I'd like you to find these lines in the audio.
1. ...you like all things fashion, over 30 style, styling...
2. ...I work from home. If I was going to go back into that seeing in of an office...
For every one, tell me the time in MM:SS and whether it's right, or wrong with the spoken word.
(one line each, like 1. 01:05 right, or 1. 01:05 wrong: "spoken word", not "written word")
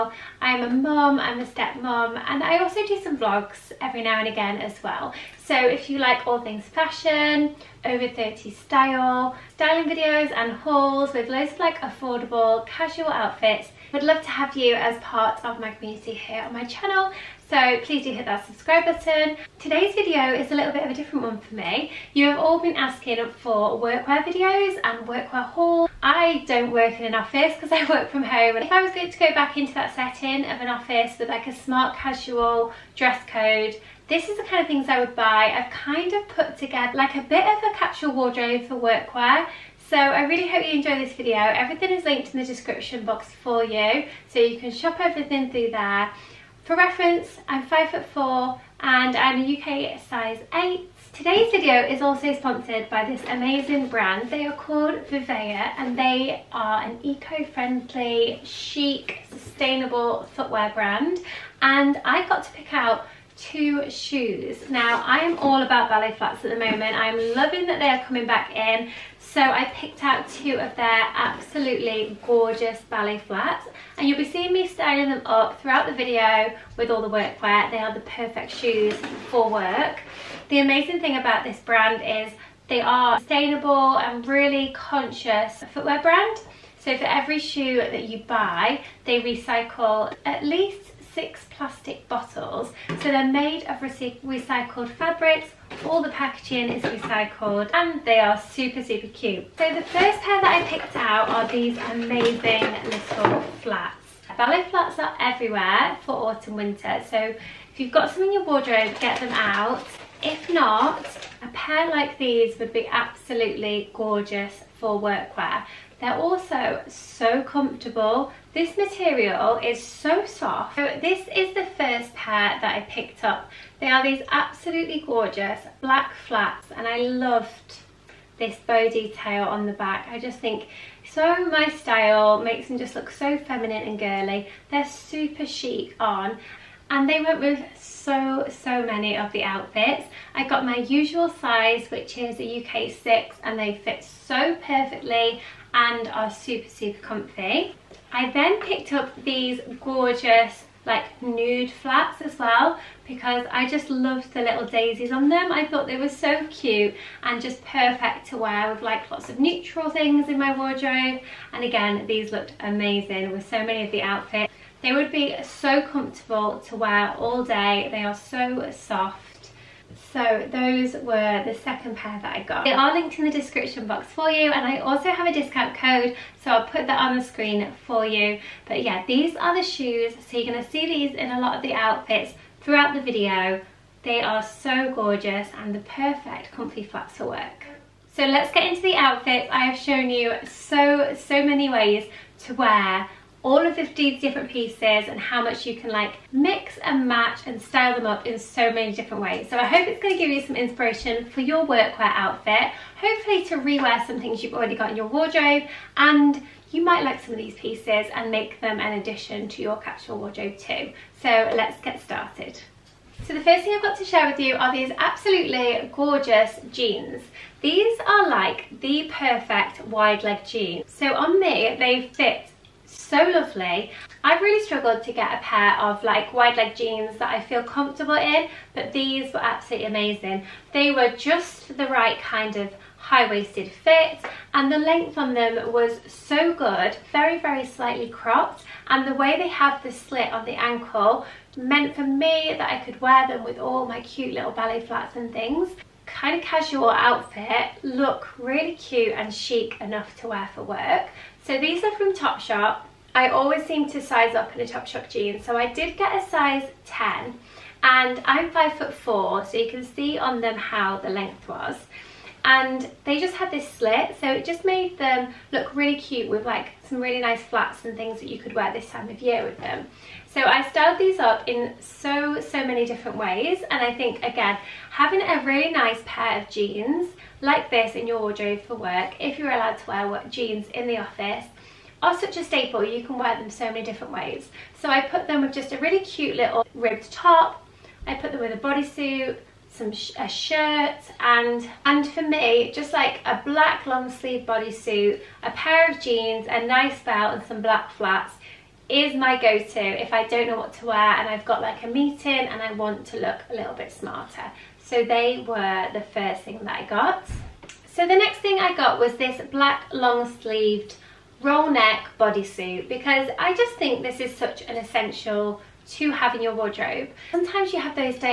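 1. 00:05 right
2. 00:27 wrong: "setting", not "seeing".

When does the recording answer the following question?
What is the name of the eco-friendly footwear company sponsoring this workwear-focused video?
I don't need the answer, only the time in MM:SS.
00:55.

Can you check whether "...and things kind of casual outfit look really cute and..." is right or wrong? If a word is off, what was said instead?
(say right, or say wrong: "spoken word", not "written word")
right.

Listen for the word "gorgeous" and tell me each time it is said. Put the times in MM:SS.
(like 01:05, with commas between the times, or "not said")
01:12, 01:53, 02:05, 02:29, 03:04, 03:35.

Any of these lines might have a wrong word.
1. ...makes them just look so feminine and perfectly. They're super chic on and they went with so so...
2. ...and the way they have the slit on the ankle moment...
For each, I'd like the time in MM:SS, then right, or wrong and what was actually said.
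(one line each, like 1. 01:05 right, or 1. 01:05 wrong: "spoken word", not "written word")
1. 02:12 wrong: "girly", not "perfectly"
2. 03:58 wrong: "meant", not "moment".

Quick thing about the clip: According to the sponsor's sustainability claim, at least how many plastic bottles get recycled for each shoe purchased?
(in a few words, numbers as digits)
6.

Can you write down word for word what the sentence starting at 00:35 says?
I've kind of put together like a bit of a capsule wardrobe for workwear.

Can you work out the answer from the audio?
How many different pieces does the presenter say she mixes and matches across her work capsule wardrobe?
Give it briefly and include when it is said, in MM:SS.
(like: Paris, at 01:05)
15, at 03:13.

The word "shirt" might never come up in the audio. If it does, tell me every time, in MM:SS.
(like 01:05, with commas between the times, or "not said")
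04:50.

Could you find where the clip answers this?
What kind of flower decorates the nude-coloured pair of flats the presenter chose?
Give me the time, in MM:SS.
02:34.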